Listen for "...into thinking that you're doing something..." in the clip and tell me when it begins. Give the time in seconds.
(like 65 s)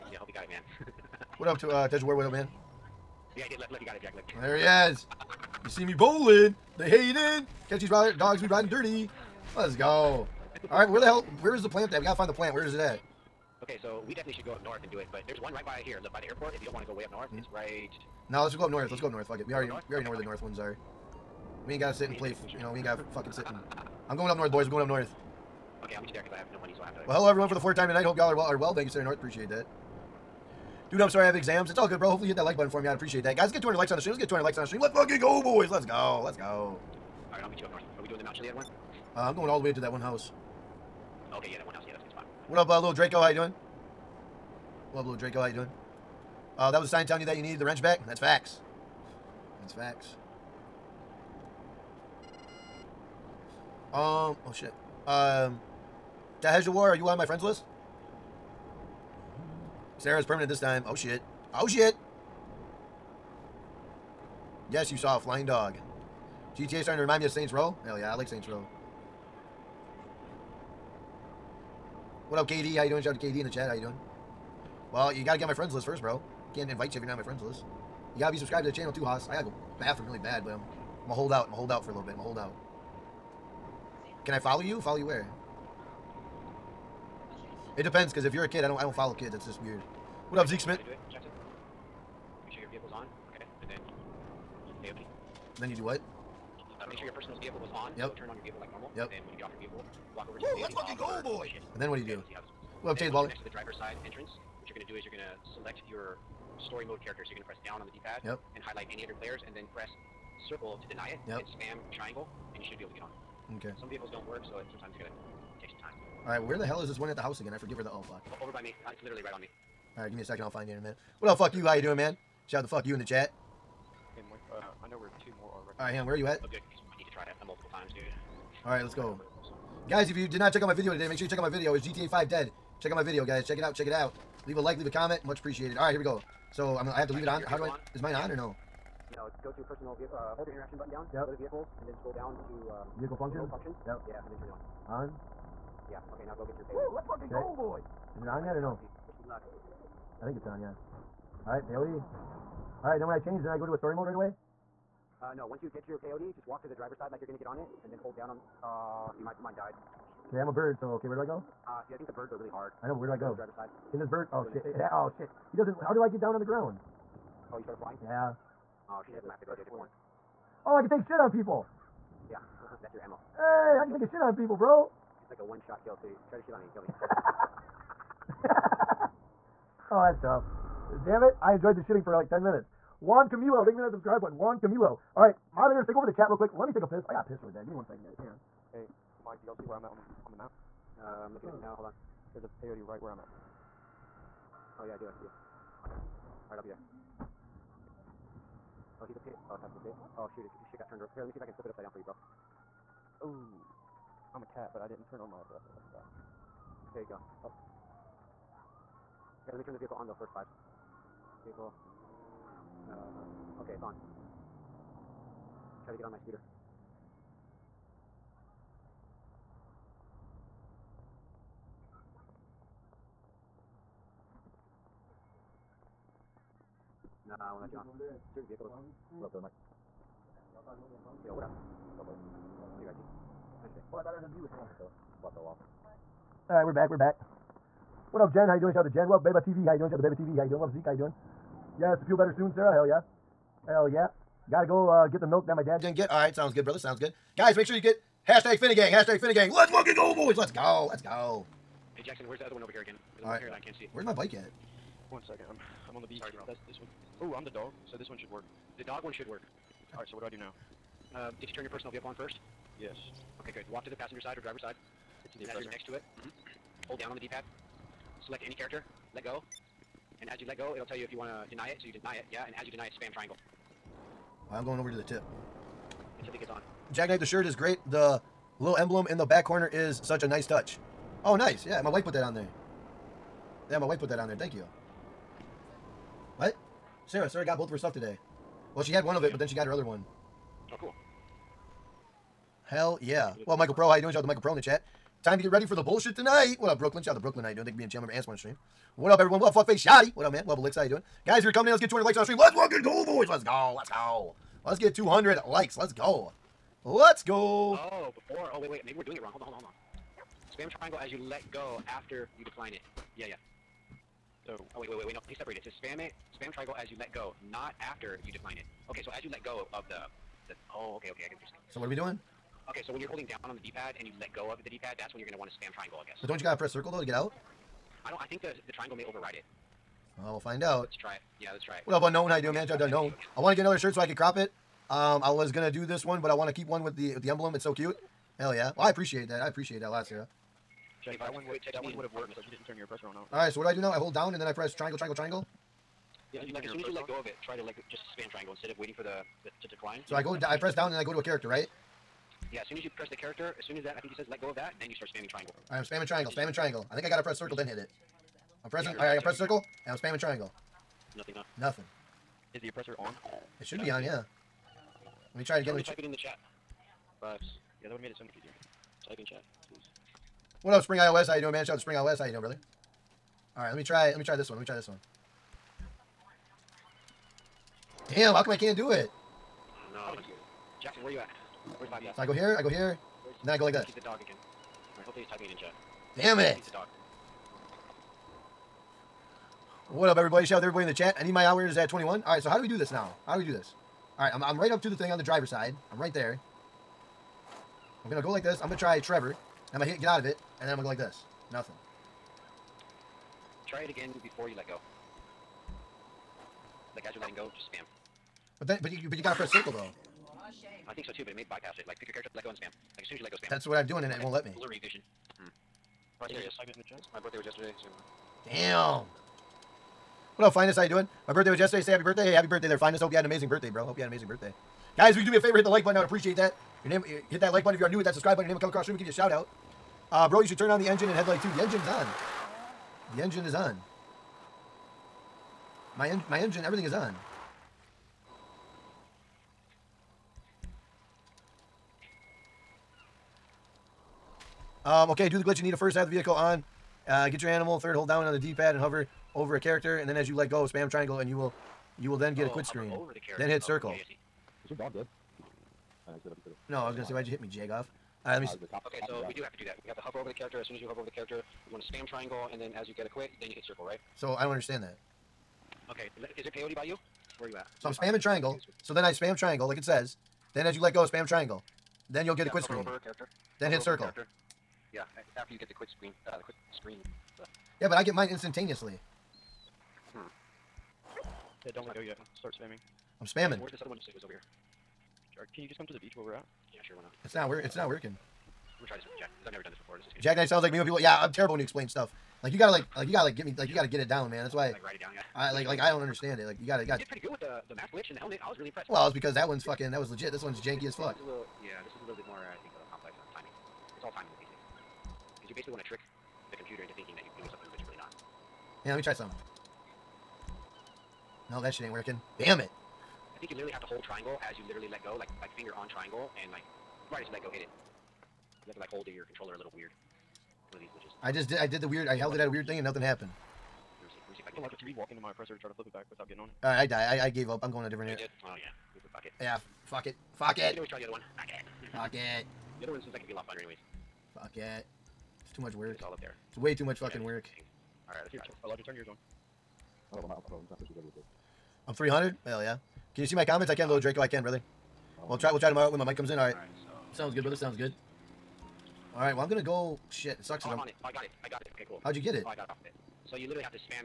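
506 s.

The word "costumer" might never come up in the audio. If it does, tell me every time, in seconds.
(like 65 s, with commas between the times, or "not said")
not said.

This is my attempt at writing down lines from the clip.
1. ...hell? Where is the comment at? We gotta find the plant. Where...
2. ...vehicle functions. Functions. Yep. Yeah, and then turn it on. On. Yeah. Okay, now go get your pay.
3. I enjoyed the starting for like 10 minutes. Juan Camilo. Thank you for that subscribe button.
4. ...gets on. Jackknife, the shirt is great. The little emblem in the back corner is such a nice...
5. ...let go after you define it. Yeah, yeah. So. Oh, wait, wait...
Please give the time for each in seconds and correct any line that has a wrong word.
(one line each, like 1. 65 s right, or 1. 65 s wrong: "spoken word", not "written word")
1. 11 s wrong: "plant", not "comment"
2. 142 s right
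3. 181 s wrong: "shitting", not "starting"
4. 276 s right
5. 311 s wrong: "decline", not "define".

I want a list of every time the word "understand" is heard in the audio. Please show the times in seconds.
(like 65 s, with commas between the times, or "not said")
464 s, 496 s.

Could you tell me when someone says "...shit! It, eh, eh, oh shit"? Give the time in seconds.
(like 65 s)
164 s.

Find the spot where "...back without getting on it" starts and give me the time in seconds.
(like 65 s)
525 s.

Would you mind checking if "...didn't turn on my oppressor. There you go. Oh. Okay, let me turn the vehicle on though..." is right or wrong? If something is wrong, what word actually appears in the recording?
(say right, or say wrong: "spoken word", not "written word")
right.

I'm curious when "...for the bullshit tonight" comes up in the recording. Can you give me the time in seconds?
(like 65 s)
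295 s.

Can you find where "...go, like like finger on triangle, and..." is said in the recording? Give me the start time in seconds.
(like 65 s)
515 s.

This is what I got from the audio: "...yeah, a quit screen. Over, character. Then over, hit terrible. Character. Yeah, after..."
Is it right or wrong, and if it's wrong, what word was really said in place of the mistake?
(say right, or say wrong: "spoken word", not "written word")
wrong: "circle", not "terrible".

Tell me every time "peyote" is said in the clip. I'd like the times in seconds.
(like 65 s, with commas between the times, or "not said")
151 s, 156 s, 192 s, 466 s.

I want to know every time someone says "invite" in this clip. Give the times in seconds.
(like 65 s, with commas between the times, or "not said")
76 s.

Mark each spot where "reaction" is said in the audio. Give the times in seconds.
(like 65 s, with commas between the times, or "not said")
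not said.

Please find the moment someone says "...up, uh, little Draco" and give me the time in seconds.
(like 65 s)
42 s.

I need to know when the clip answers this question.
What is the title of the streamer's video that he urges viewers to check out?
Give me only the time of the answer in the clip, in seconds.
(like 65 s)
131 s.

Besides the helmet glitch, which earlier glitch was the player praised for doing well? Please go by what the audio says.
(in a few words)
mask glitch.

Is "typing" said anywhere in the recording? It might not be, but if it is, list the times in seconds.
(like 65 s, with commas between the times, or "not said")
385 s.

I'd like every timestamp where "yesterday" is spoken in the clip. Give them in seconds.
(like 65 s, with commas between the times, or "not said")
417 s, 421 s.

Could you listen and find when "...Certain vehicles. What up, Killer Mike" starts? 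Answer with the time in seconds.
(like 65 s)
228 s.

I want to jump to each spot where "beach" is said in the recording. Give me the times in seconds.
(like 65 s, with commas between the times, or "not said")
256 s, 486 s.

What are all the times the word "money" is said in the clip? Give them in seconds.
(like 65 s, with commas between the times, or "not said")
26 s.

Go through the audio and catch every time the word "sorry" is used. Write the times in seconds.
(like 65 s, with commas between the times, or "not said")
31 s, 256 s.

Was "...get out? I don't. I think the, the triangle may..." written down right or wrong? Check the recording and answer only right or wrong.
right.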